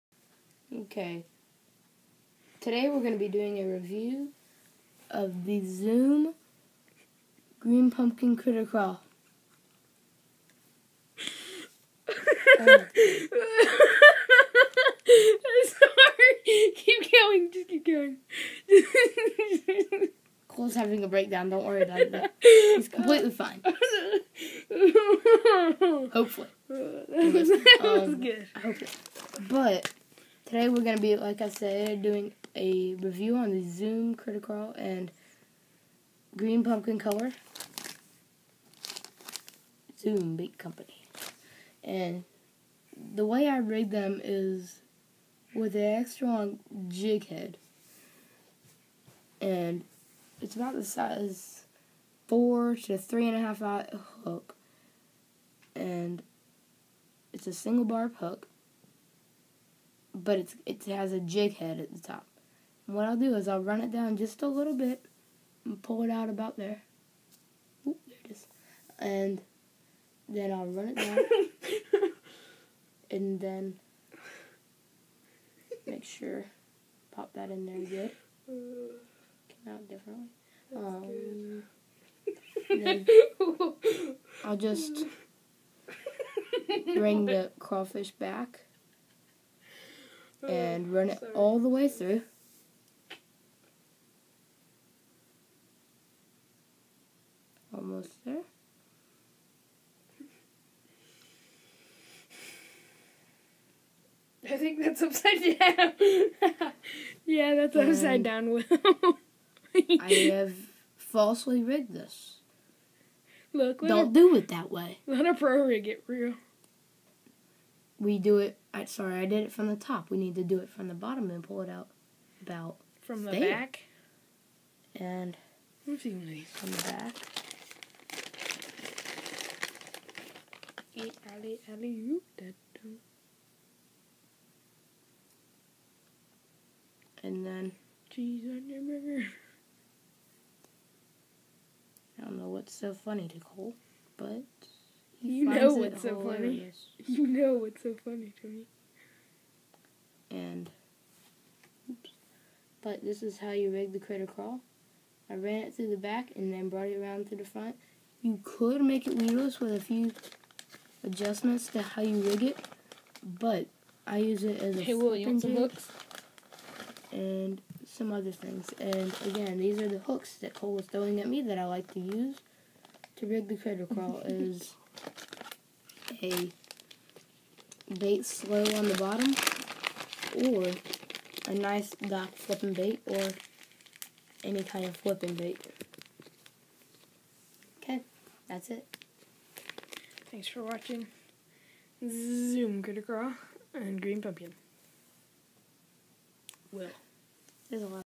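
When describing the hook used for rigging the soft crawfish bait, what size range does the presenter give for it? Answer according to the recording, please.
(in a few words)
4 to 3.5.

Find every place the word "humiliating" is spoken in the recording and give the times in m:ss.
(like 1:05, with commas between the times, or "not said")
not said.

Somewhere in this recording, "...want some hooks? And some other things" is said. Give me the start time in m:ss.
2:45.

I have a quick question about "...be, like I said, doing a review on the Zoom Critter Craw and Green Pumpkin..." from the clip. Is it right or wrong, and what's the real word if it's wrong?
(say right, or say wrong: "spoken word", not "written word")
right.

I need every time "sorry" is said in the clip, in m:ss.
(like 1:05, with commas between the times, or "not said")
0:12, 1:58.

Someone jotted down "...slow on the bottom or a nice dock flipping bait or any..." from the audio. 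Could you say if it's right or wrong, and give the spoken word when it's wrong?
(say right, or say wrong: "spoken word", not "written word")
right.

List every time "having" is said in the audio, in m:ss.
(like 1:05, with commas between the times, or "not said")
0:20.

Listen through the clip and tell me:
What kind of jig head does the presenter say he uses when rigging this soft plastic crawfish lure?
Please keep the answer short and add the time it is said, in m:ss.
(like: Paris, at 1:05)
Extra long jig head, at 0:46.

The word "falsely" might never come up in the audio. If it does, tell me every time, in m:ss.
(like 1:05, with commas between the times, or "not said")
1:50.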